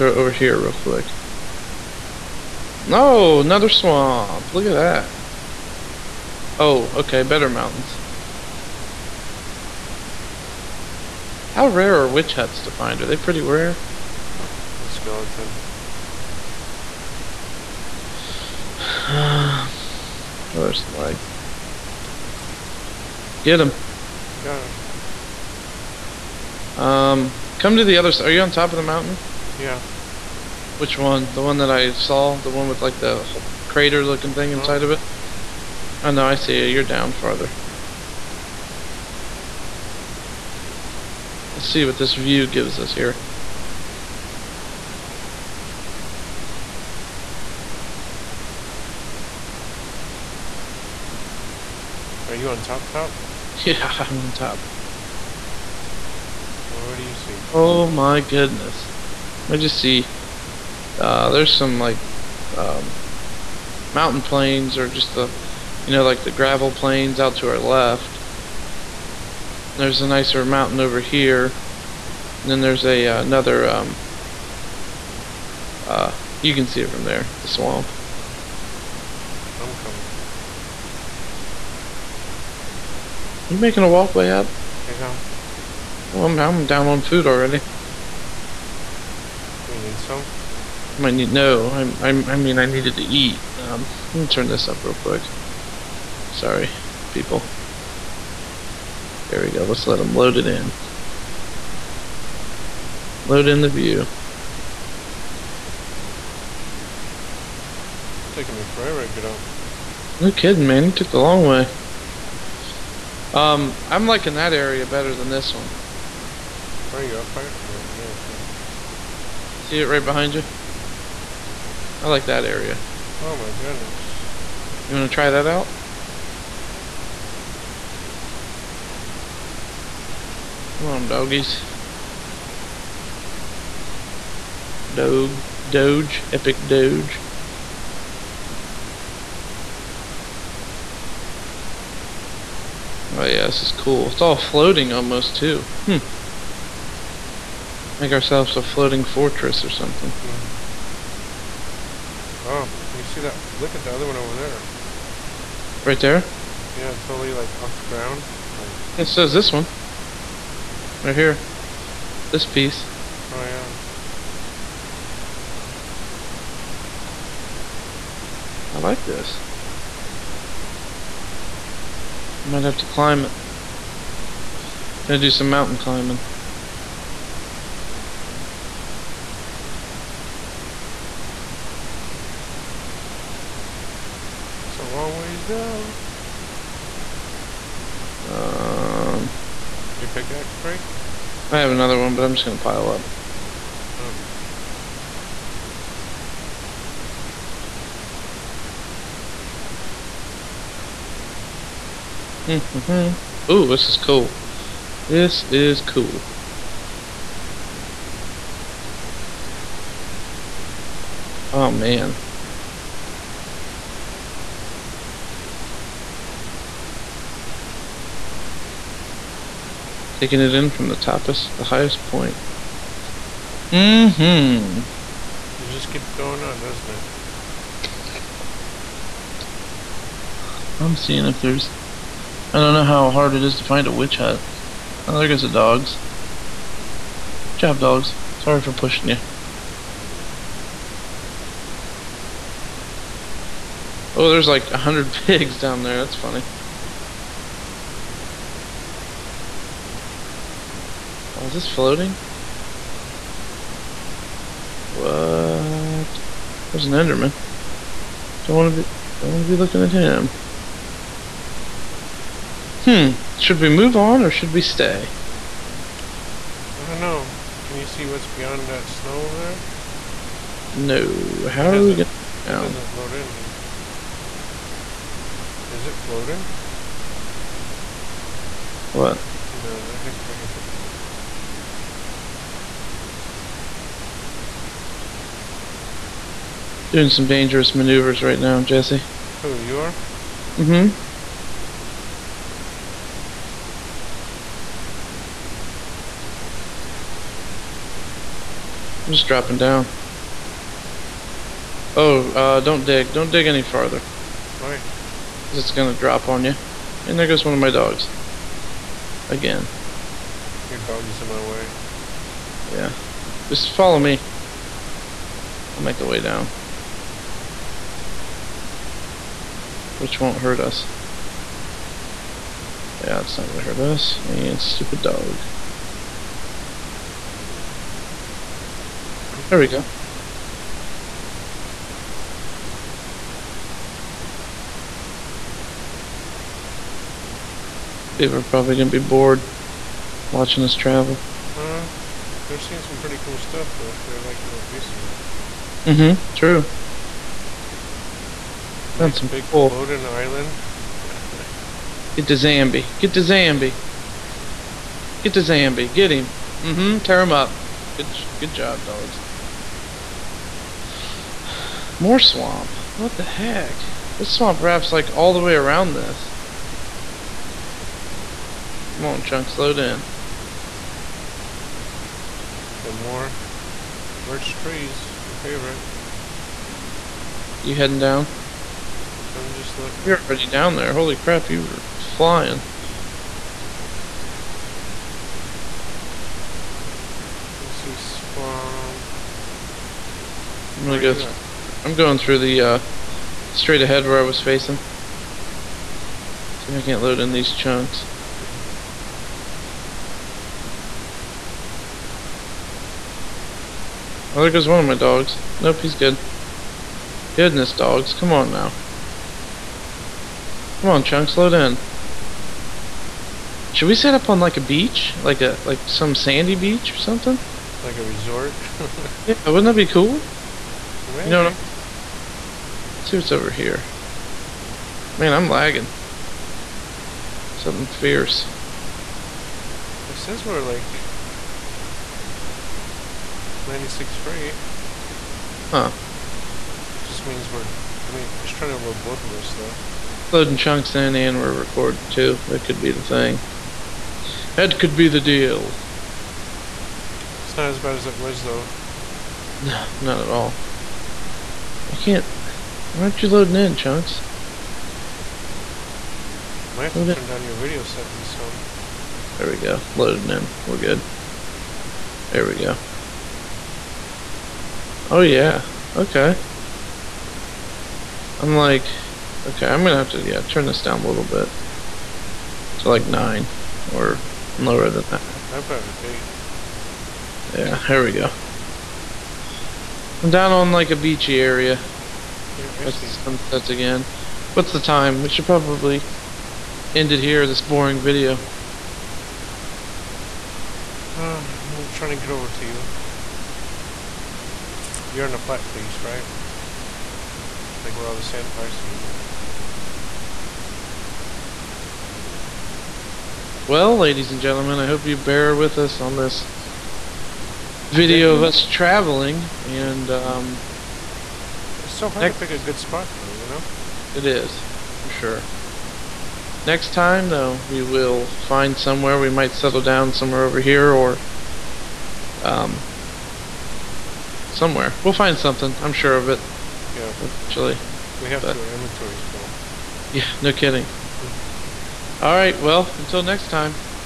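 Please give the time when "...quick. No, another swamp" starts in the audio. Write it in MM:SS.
00:00.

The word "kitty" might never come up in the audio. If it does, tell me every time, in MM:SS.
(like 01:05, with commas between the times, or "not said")
not said.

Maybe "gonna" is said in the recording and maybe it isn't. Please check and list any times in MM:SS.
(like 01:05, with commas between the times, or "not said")
02:55, 03:12, 05:23, 05:38, 06:30, 07:49.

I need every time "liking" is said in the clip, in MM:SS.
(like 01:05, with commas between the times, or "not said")
01:54, 05:44.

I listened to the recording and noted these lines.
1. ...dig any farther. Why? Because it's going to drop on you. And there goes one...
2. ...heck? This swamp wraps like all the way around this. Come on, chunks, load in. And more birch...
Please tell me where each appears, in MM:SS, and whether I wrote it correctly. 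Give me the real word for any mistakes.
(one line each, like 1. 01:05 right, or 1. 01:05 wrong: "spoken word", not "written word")
1. 05:03 right
2. 06:03 right.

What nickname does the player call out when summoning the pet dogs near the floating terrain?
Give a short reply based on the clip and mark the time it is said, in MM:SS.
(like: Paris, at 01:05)
Epic Doge, at 02:16.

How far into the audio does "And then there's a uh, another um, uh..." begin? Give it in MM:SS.
01:12.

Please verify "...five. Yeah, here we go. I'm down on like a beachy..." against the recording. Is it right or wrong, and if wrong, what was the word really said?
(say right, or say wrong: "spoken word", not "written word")
wrong: "eight", not "five".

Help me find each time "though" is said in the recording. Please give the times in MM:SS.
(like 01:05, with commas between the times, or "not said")
05:43, 07:19, 07:28, 08:33, 08:37.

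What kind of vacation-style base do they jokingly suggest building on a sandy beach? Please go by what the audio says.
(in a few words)
A resort.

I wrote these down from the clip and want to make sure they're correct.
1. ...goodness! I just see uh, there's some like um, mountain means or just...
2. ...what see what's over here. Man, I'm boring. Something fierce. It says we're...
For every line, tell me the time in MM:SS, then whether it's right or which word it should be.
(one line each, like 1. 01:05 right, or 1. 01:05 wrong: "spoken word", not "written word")
1. 00:58 wrong: "plains", not "means"
2. 07:01 wrong: "lagging", not "boring".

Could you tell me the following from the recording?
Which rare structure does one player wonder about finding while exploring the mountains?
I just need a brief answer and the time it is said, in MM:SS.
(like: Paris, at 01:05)
Witch huts, at 00:12.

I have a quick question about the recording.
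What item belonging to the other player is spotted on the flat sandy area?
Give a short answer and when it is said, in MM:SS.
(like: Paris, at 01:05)
Bed, at 08:18.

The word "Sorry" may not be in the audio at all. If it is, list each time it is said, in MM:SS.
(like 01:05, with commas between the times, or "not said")
01:36, 03:58.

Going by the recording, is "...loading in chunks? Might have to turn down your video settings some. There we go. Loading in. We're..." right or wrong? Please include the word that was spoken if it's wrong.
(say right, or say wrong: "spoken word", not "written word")
right.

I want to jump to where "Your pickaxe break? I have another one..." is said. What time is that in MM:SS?
03:10.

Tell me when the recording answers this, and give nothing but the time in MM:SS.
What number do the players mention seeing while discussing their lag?
07:13.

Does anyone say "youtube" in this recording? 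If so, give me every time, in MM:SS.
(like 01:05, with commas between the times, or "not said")
not said.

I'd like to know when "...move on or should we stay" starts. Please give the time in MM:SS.
04:23.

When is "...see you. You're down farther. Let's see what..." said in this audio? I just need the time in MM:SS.
00:36.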